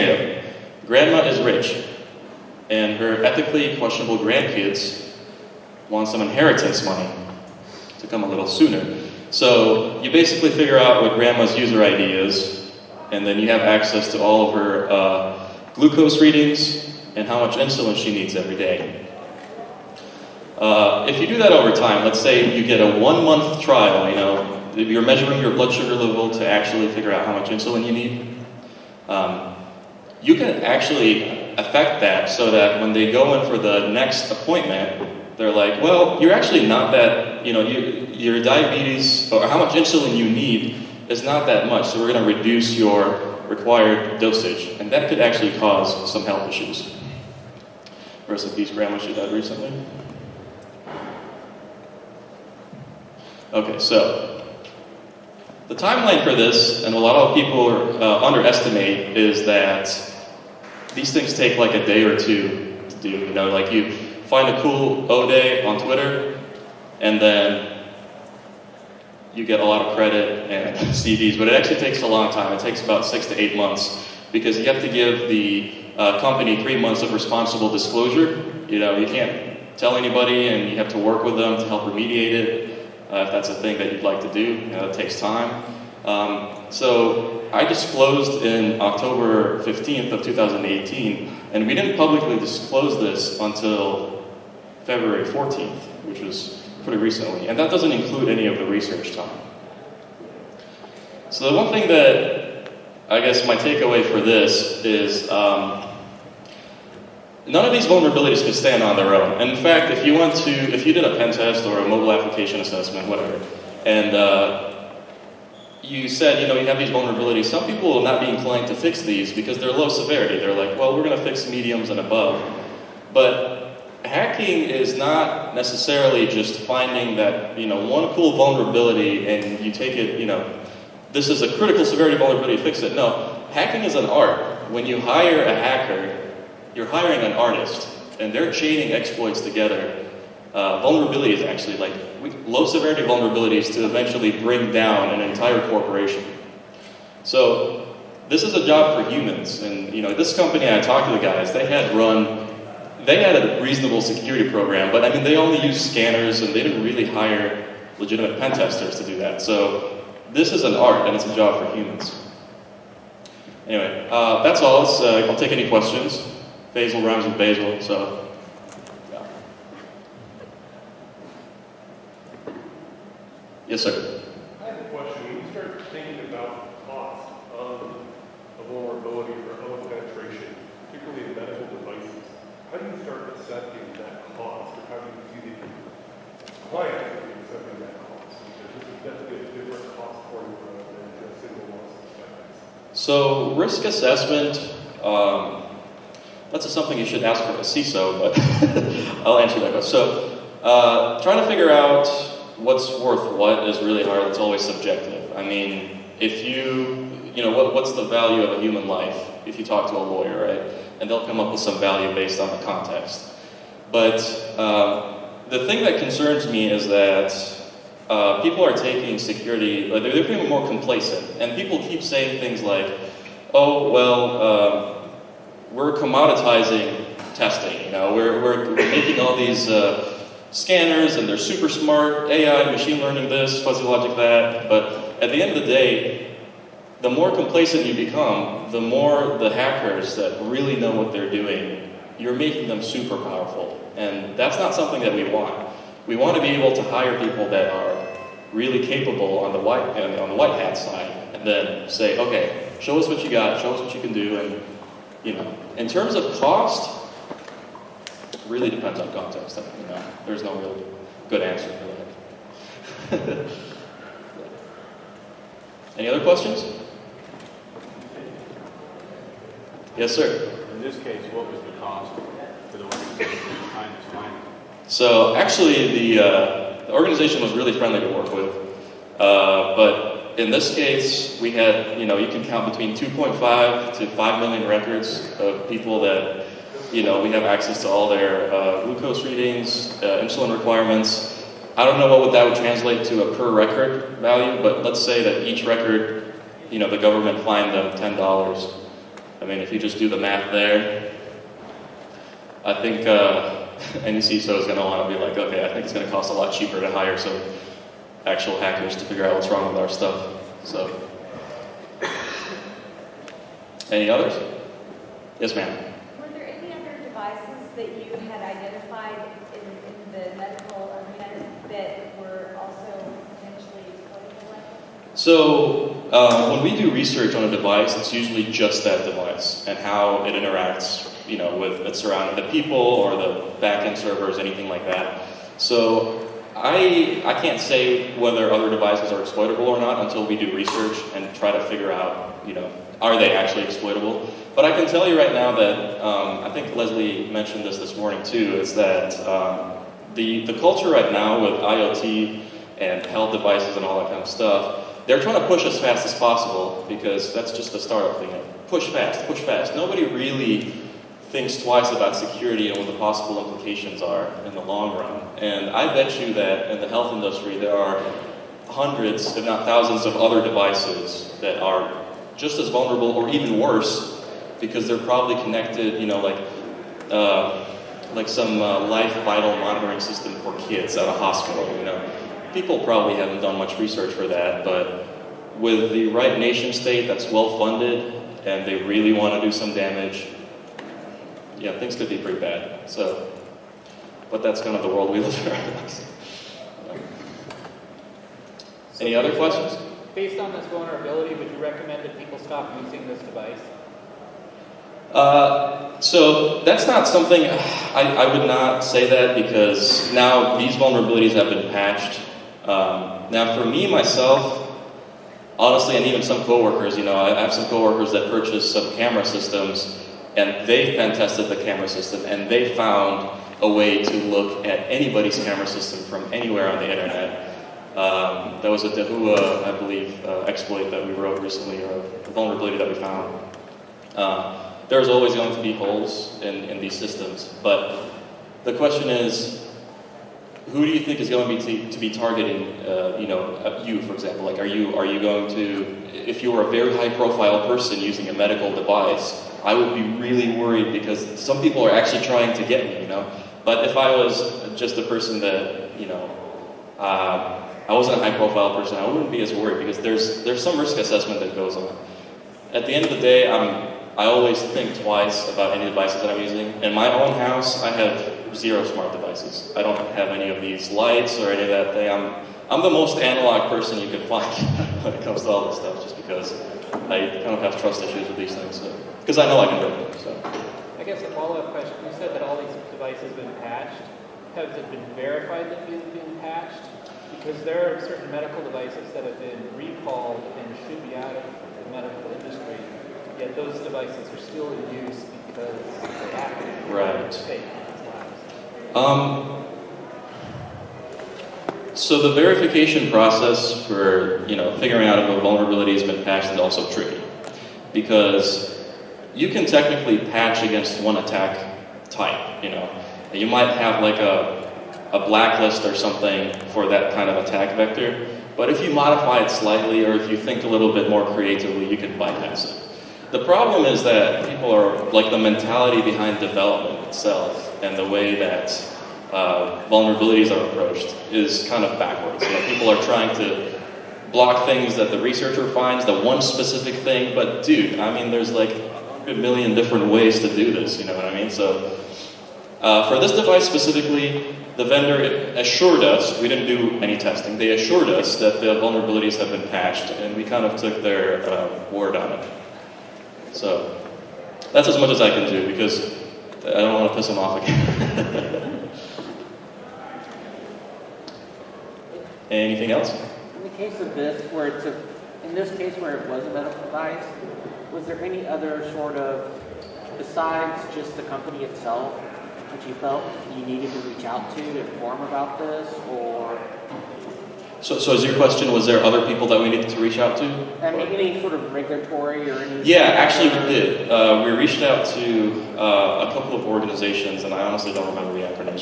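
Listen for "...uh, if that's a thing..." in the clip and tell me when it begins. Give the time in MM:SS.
01:23.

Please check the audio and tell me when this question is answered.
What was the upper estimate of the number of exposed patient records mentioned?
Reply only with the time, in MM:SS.
04:44.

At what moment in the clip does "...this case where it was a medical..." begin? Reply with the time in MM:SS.
09:25.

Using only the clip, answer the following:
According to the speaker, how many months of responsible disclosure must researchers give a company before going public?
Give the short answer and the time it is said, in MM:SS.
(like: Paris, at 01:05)
3 months, at 01:16.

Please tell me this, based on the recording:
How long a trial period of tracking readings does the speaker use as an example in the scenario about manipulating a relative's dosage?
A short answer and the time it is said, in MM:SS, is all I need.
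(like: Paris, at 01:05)
one month, at 00:22.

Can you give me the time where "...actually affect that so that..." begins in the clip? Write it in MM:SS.
00:30.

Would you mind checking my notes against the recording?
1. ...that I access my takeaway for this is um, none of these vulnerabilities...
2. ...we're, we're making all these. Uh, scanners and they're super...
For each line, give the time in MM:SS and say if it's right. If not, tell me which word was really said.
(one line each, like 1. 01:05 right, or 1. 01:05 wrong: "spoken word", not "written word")
1. 01:41 wrong: "guess", not "access"
2. 03:48 right.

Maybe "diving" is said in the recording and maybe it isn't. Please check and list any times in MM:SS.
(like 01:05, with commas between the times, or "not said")
not said.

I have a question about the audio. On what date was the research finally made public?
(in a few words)
February 14.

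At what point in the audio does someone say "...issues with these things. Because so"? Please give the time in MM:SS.
07:58.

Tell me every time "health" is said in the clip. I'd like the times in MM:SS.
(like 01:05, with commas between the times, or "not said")
00:46, 05:53, 06:06.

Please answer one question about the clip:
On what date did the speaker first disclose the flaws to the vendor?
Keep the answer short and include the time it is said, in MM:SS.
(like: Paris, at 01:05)
October 15, 2018, at 01:28.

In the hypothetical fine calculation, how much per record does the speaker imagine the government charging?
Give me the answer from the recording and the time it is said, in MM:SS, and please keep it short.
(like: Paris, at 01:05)
$10, at 04:57.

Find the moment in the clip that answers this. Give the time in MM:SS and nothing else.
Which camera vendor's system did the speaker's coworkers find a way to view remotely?
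07:08.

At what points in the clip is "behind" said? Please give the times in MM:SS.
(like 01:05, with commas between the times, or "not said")
04:33, 08:46.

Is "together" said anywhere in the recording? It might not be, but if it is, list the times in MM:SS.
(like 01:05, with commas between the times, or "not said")
02:19.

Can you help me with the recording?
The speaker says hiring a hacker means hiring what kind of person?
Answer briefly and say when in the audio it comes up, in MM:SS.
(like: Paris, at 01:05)
an artist, at 02:17.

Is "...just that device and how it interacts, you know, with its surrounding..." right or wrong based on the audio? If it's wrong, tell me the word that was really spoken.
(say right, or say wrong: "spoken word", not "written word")
right.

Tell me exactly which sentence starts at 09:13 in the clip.
So that's as much as I can do because I don't want to piss them off again.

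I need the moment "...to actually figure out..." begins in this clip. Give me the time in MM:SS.
00:26.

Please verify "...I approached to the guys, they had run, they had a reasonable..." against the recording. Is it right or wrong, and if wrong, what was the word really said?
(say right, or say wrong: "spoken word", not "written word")
wrong: "talked", not "approached".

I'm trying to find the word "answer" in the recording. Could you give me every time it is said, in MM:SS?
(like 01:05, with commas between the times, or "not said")
03:19, 04:21.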